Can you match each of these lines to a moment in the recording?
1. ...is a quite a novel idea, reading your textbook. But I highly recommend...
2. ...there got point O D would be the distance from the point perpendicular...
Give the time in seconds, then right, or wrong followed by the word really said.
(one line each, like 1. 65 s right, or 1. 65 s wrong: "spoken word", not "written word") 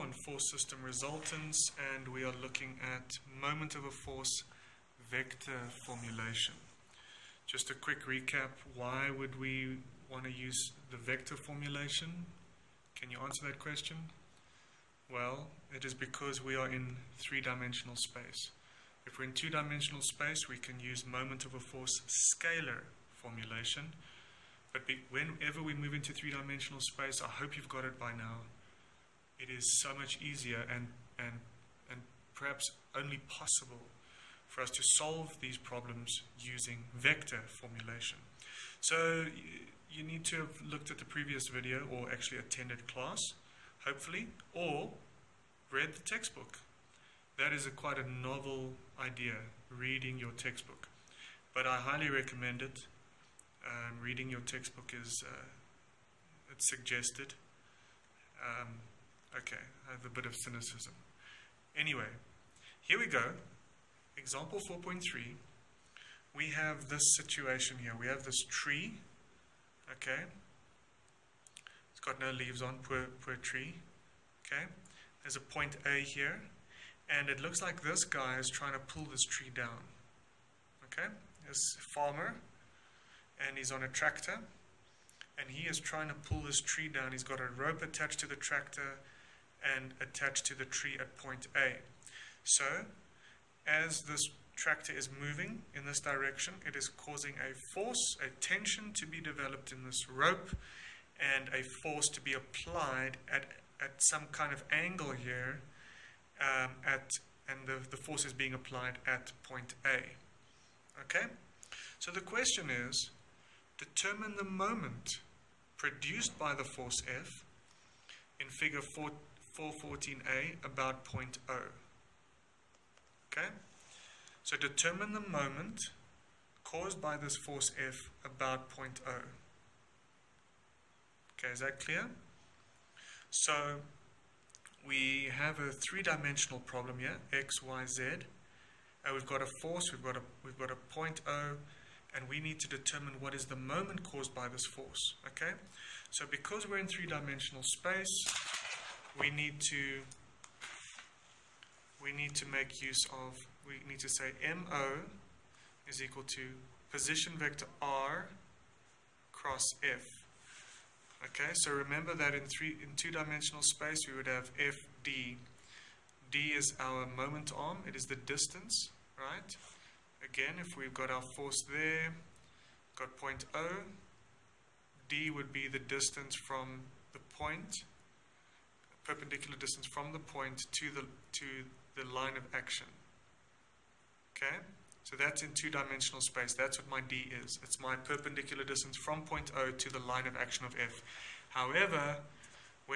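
1. 47 s right
2. 171 s right.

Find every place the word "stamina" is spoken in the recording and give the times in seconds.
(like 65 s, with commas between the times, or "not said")
not said.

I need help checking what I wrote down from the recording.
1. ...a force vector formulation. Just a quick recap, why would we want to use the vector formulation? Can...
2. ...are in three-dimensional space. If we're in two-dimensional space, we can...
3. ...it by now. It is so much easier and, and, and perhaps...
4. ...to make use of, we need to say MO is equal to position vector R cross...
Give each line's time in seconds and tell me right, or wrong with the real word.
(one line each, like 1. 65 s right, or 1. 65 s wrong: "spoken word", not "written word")
1. 3 s right
2. 16 s right
3. 27 s right
4. 152 s right.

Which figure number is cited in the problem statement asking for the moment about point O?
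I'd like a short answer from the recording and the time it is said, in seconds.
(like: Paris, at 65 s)
414A, at 118 s.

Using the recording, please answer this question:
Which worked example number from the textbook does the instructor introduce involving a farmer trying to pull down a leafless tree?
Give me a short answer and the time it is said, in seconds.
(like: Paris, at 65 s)
Example 4.3, at 64 s.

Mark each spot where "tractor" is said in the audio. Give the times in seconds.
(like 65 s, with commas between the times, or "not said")
83 s, 88 s, 94 s.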